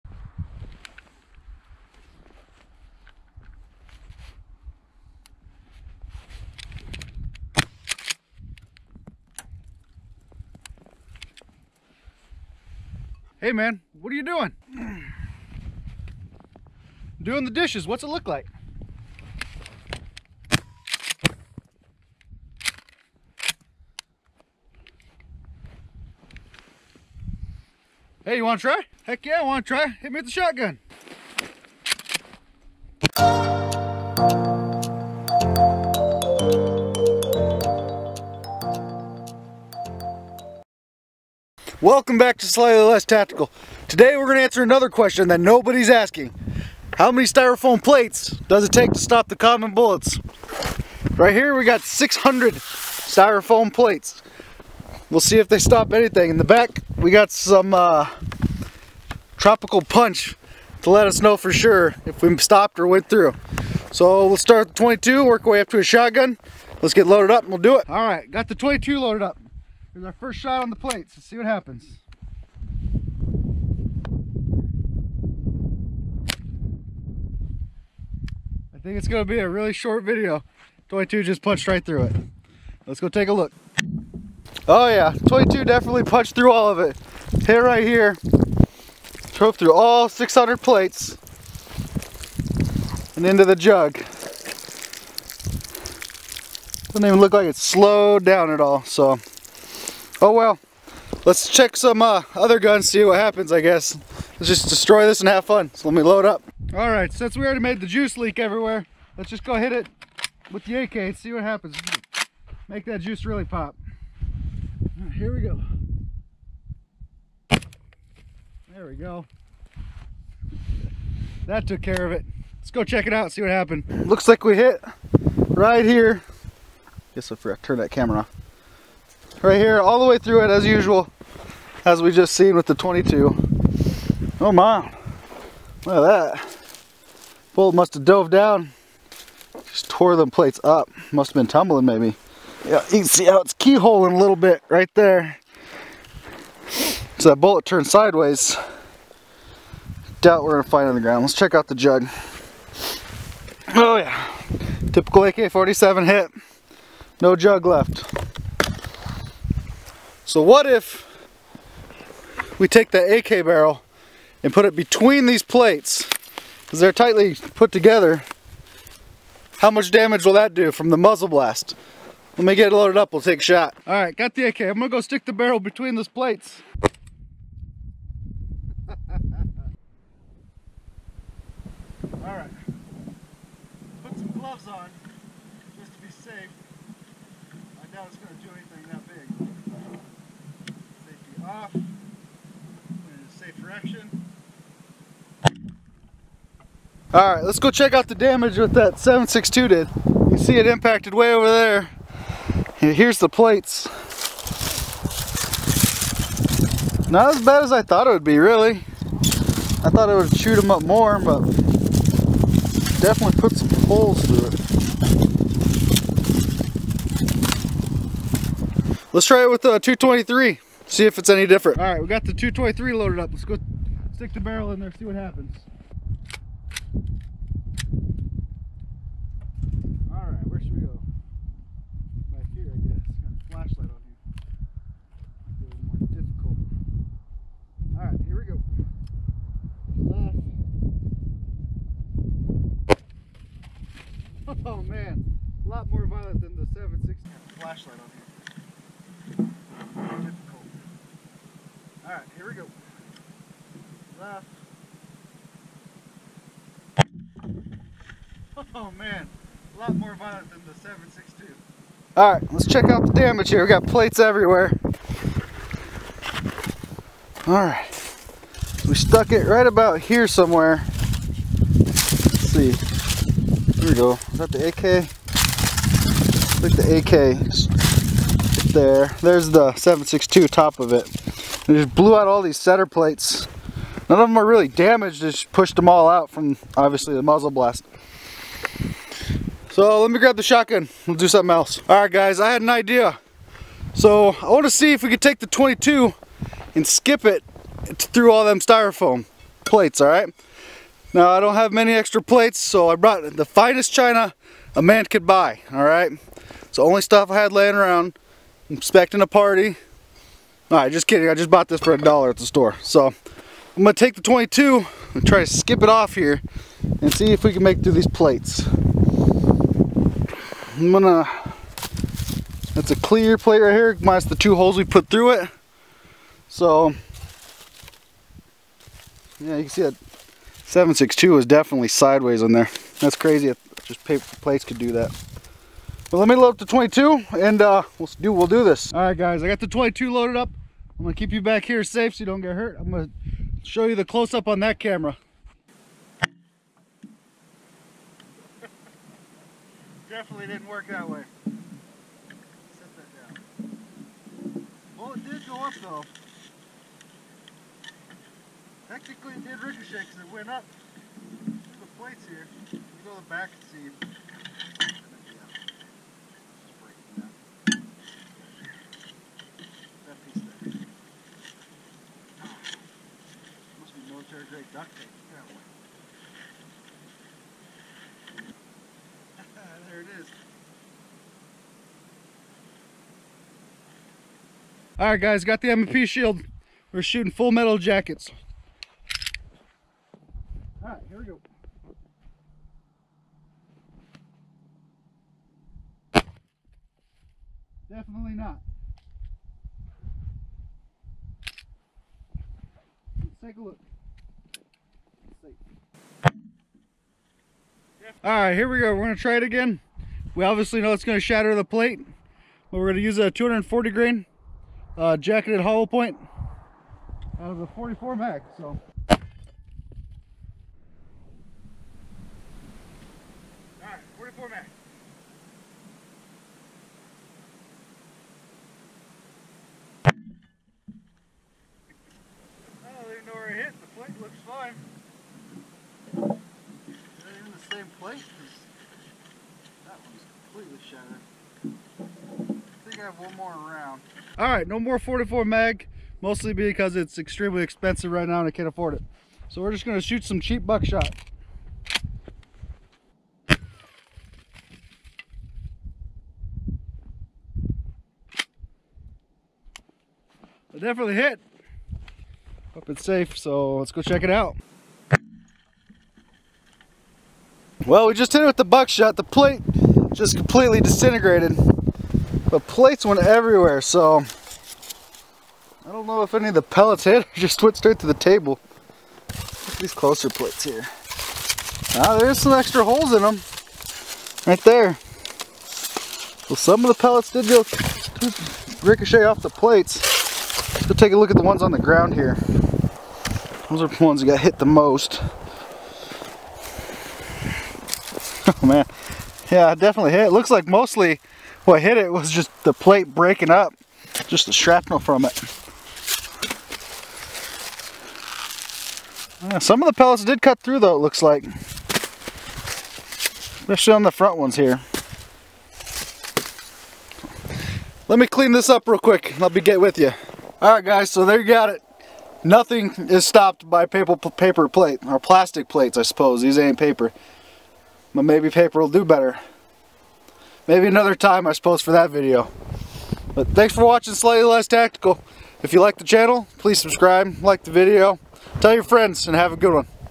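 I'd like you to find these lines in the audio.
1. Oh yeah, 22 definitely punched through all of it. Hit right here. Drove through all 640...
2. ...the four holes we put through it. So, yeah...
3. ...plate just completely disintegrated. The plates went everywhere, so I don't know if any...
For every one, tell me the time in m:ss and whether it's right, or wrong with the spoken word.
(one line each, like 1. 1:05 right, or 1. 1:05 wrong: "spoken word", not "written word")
1. 1:24 wrong: "600", not "640"
2. 5:24 wrong: "two", not "four"
3. 7:49 right.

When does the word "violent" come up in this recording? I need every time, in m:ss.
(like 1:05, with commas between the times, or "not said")
4:06, 4:20.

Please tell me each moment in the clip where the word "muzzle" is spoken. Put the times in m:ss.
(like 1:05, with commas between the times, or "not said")
2:50, 4:47.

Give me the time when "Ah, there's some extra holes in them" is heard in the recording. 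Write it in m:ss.
8:02.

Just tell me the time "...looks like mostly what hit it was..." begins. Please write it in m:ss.
8:20.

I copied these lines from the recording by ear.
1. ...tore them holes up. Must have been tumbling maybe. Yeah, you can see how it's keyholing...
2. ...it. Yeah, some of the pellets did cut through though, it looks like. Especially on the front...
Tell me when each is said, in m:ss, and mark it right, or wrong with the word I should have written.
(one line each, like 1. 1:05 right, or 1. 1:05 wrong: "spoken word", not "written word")
1. 2:19 wrong: "plates", not "holes"
2. 8:25 right.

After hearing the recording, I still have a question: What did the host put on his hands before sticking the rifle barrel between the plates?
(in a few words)
gloves.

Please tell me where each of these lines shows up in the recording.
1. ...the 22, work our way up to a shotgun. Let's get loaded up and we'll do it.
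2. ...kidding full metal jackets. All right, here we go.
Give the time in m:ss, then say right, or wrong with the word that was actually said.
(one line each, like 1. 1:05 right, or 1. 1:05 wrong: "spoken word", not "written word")
1. 1:04 right
2. 6:27 wrong: "shooting", not "kidding".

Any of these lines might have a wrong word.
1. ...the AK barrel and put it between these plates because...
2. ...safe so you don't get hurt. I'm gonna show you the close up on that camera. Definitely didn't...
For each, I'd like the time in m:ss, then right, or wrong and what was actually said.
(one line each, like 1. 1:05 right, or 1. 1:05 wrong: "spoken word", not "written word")
1. 2:42 right
2. 5:41 right.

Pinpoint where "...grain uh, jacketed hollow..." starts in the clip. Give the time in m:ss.
6:53.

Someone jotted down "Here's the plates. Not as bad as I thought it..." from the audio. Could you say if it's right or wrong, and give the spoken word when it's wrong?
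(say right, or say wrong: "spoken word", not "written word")
right.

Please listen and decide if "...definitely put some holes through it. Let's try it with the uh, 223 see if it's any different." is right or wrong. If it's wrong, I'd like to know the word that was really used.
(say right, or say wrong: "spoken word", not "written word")
right.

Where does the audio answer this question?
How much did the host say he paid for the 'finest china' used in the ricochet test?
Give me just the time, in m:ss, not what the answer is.
5:11.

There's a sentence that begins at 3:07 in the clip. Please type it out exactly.
I doubt it's gonna do anything that off in a safe direction.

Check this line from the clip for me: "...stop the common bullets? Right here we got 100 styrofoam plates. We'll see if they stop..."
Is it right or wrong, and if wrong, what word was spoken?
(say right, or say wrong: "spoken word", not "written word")
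wrong: "600", not "100".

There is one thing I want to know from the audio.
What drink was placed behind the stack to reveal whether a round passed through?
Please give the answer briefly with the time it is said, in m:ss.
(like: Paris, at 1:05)
tropical punch, at 0:59.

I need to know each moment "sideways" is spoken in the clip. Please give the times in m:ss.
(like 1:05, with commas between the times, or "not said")
2:27, 5:31.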